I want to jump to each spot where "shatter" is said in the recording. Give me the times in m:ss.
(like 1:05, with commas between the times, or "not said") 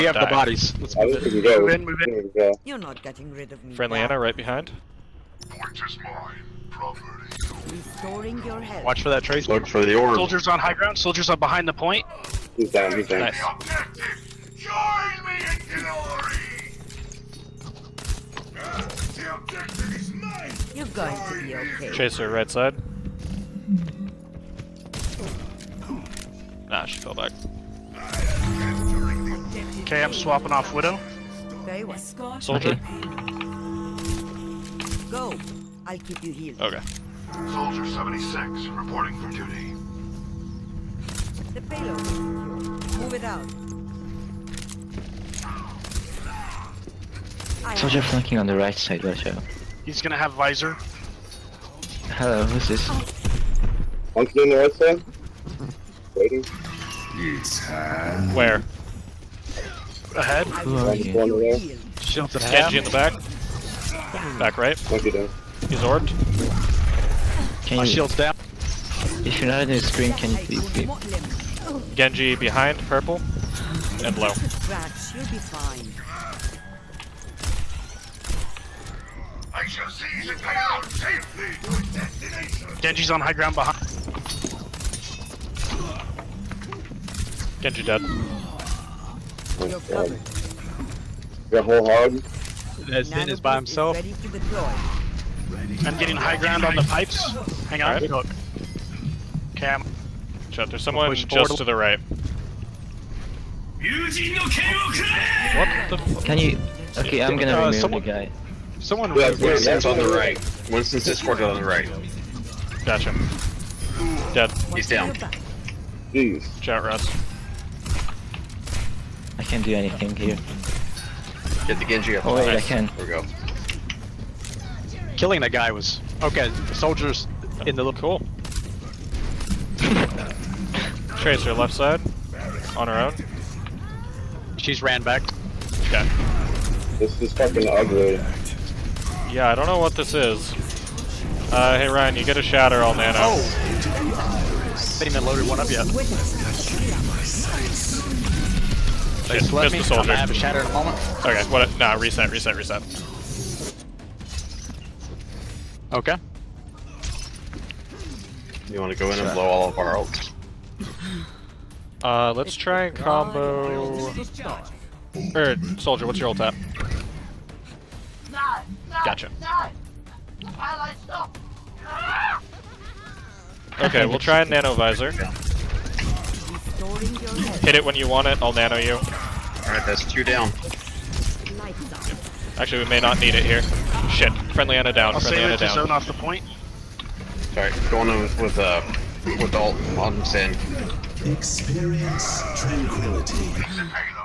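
2:22, 2:30.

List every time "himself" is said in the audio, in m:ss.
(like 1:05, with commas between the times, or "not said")
1:33.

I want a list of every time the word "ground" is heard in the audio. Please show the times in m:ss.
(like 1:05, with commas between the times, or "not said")
0:10, 1:23, 1:36.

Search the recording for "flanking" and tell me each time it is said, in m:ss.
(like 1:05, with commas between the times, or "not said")
0:48, 0:54.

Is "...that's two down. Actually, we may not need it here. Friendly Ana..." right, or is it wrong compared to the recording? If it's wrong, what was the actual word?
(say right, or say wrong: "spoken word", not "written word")
right.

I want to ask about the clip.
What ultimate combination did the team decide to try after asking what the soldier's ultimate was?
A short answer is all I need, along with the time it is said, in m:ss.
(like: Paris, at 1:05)
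nano visor, at 2:54.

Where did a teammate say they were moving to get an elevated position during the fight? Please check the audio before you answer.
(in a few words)
the pipes.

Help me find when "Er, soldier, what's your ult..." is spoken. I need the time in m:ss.
2:45.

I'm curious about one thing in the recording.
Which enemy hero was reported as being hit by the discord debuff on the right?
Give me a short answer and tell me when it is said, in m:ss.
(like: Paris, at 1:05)
Winston, at 1:50.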